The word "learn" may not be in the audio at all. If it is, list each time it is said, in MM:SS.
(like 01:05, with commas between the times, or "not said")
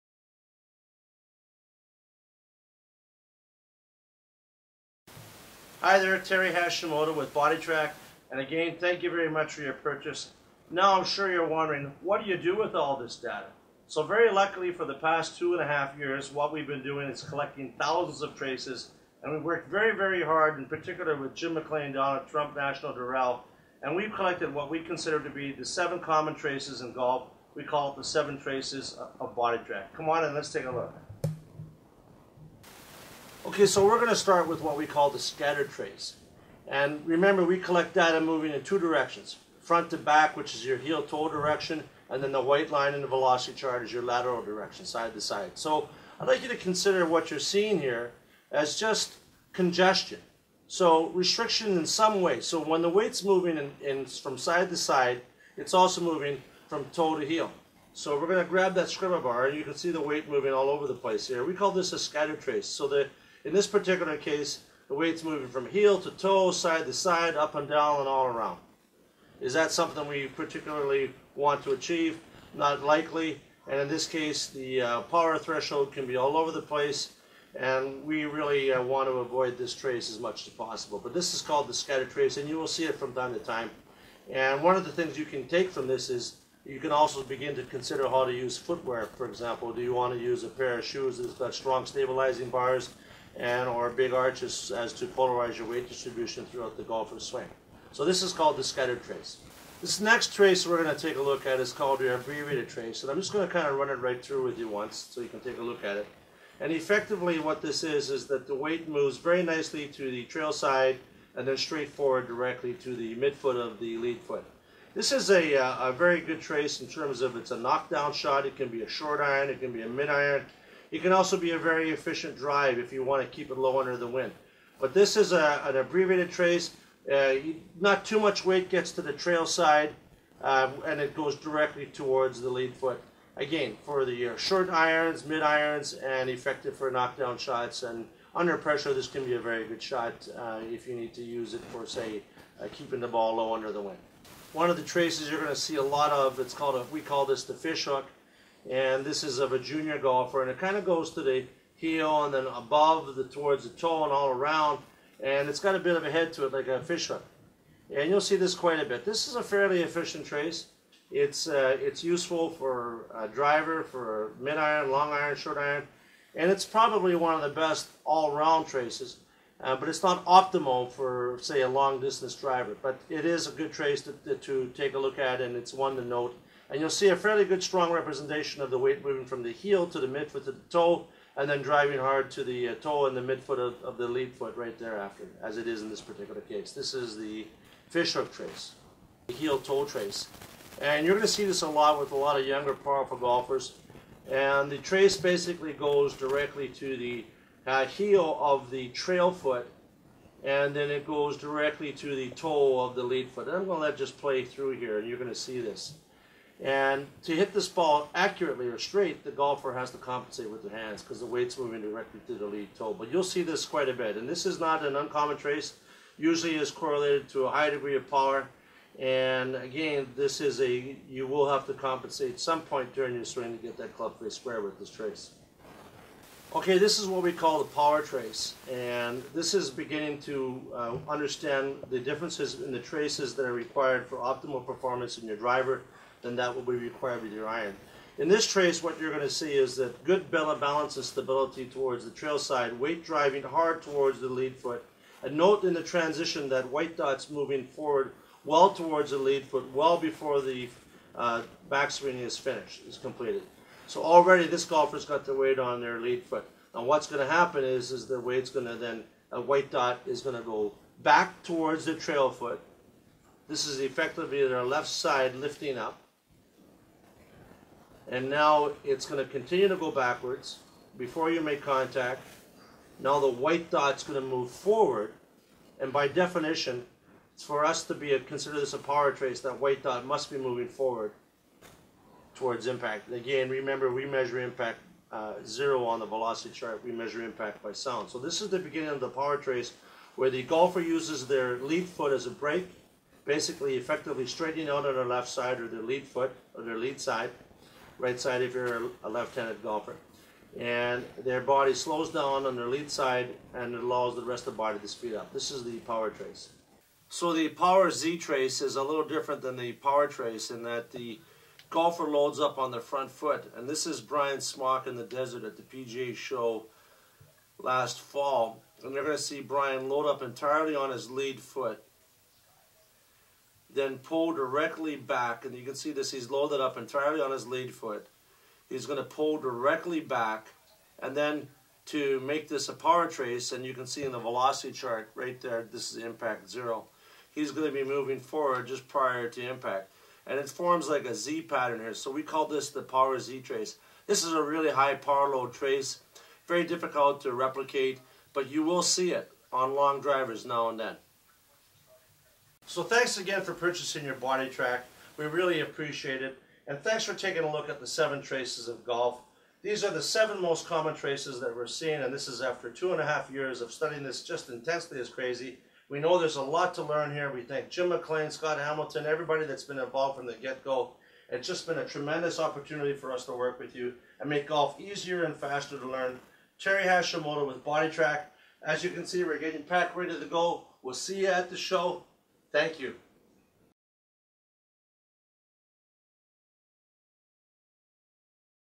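06:06, 06:15.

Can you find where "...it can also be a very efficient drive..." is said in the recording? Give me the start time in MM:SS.
02:00.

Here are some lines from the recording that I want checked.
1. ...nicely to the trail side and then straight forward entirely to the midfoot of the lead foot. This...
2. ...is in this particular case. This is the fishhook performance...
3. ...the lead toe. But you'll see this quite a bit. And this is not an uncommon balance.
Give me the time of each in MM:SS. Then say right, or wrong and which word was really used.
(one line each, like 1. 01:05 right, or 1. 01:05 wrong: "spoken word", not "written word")
1. 01:49 wrong: "directly", not "entirely"
2. 03:05 wrong: "trace", not "performance"
3. 03:32 wrong: "trace", not "balance".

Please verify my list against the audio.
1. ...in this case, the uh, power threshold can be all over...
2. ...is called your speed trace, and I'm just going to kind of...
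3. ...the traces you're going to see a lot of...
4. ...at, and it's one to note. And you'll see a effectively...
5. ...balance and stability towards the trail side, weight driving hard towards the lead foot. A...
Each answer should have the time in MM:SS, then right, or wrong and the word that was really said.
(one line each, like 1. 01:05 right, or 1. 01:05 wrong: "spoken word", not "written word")
1. 01:13 right
2. 01:41 wrong: "abbreviated", not "speed"
3. 02:24 right
4. 02:55 wrong: "fairly", not "effectively"
5. 04:00 right.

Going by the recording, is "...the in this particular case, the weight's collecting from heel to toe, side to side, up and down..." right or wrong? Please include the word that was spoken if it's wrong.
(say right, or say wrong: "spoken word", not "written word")
wrong: "moving", not "collecting".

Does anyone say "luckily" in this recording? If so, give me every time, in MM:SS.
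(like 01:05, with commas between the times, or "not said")
00:14.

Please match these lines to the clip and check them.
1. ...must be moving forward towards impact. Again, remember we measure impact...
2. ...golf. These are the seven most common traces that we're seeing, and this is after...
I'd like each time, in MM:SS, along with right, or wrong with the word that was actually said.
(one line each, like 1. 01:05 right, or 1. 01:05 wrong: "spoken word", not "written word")
1. 04:40 right
2. 05:58 right.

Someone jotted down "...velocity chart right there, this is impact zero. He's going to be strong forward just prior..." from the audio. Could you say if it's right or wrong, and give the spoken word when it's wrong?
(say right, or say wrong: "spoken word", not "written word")
wrong: "moving", not "strong".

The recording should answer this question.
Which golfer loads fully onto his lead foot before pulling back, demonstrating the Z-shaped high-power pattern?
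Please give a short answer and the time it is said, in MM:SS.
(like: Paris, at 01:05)
Brian Smock, at 05:14.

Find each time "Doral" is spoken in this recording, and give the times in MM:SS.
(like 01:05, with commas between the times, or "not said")
00:22.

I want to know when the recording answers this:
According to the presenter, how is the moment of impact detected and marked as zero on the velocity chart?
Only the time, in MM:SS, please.
04:47.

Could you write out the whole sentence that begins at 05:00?
And their body slows down on their lead side and it allows the rest of the body to speed up.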